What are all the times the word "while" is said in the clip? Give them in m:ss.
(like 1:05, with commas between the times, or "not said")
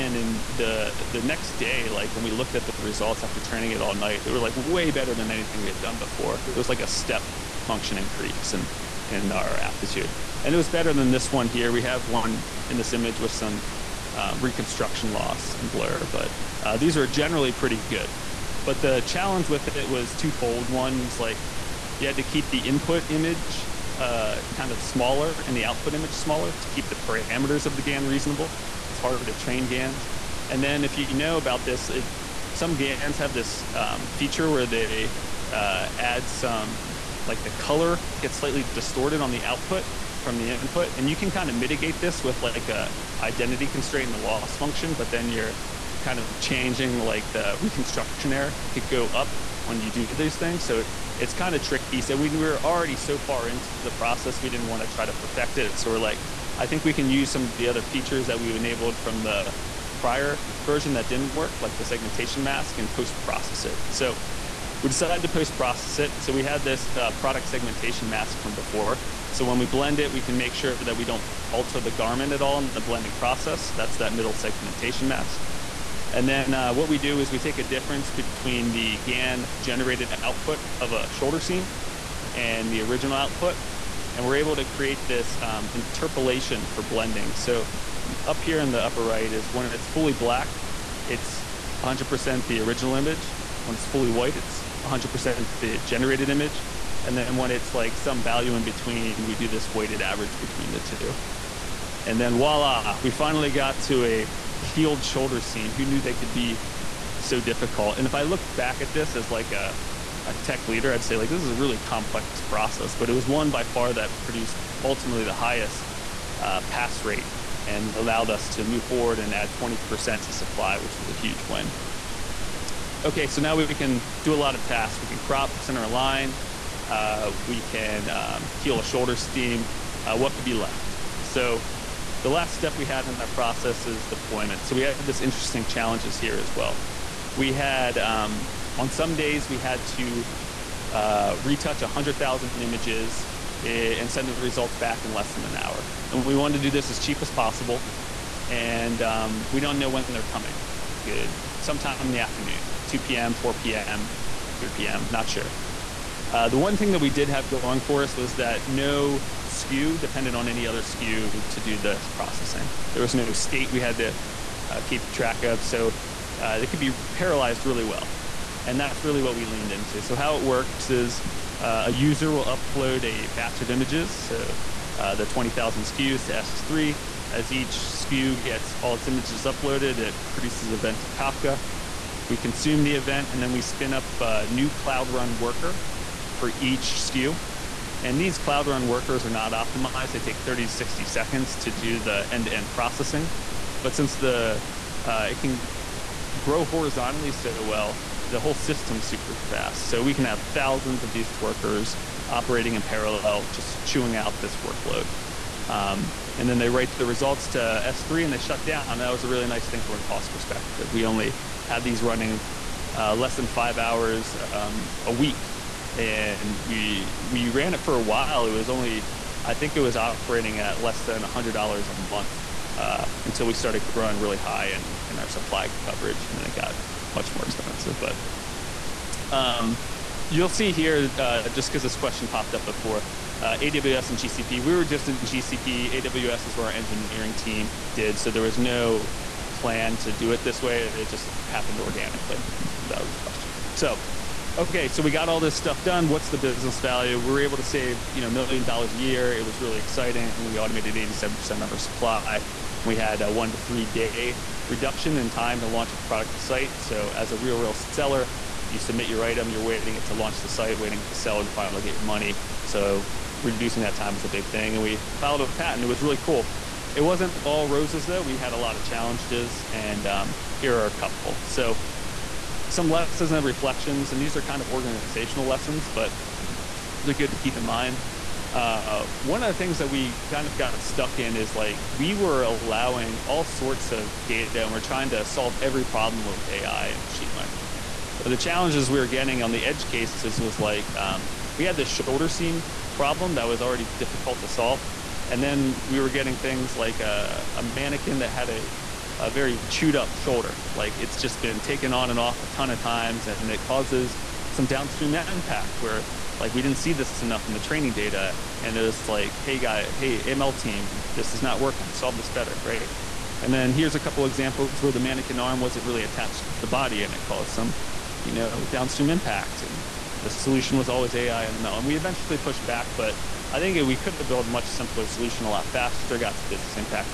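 3:38.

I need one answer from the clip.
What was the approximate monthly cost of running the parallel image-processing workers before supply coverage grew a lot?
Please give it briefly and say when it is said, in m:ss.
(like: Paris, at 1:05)
less than $100, at 3:40.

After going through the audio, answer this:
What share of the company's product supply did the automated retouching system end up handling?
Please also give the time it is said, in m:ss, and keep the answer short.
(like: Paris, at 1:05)
87%, at 4:10.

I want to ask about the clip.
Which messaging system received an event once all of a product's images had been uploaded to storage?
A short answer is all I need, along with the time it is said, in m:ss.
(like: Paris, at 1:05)
Kafka, at 3:01.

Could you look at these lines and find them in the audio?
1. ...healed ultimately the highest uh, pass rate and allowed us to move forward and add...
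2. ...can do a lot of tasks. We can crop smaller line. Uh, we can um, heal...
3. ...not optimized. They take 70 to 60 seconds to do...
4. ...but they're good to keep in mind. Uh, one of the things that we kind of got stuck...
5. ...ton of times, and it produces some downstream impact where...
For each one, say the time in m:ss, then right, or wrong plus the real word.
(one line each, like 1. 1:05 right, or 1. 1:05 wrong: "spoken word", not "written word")
1. 1:54 wrong: "produced", not "healed"
2. 2:03 wrong: "center", not "smaller"
3. 3:09 wrong: "30", not "70"
4. 4:35 right
5. 5:02 wrong: "causes", not "produces".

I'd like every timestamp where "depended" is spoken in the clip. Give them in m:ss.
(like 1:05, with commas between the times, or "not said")
2:39.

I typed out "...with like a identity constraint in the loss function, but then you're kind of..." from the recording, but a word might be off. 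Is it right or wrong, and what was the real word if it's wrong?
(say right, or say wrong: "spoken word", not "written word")
right.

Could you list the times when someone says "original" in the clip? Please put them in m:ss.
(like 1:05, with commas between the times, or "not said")
1:22, 1:32.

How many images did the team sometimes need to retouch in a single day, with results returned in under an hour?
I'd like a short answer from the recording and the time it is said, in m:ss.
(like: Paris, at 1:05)
100,000, at 2:21.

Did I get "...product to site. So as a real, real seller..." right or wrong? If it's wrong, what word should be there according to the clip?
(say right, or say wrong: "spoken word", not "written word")
right.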